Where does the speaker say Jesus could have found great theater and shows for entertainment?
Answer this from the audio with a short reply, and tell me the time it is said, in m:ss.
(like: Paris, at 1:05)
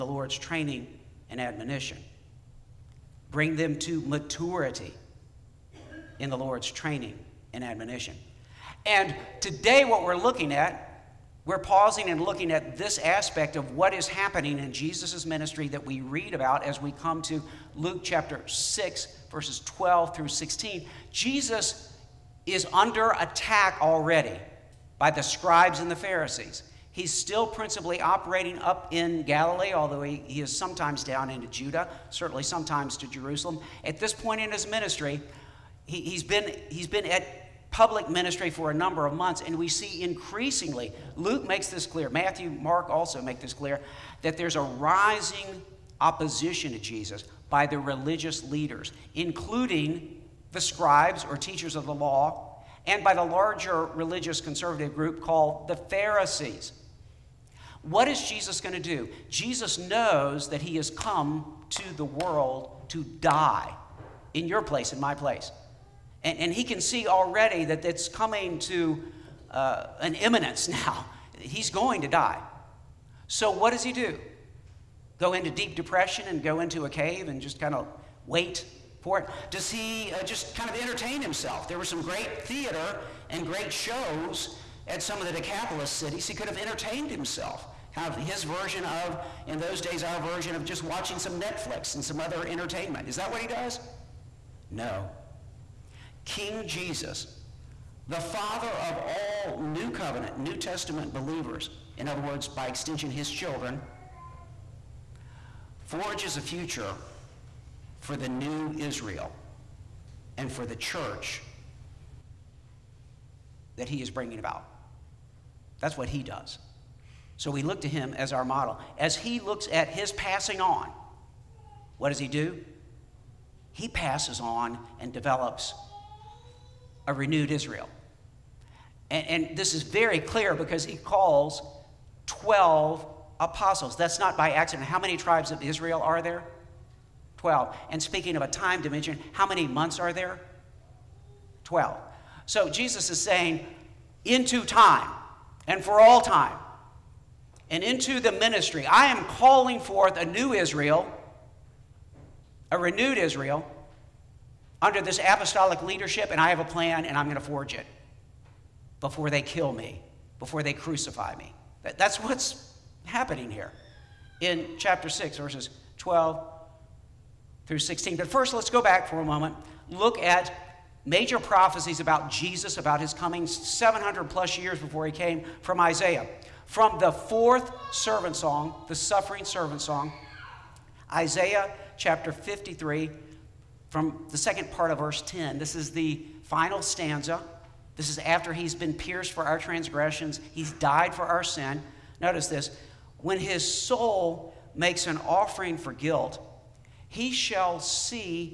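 Decapolis cities, at 1:25.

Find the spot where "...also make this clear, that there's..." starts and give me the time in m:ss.
0:42.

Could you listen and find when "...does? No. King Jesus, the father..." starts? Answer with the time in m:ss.
1:33.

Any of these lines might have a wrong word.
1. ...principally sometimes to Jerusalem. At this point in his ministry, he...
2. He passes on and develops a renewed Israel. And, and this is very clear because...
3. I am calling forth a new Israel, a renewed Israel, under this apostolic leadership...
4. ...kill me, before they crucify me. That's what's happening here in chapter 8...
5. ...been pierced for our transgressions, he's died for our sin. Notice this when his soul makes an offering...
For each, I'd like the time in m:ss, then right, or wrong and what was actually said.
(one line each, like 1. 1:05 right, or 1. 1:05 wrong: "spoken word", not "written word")
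1. 0:32 wrong: "certainly", not "principally"
2. 2:03 right
3. 2:28 right
4. 2:39 wrong: "6", not "8"
5. 3:08 right.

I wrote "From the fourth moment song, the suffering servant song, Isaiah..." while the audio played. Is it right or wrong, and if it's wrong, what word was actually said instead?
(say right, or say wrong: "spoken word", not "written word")
wrong: "servant", not "moment".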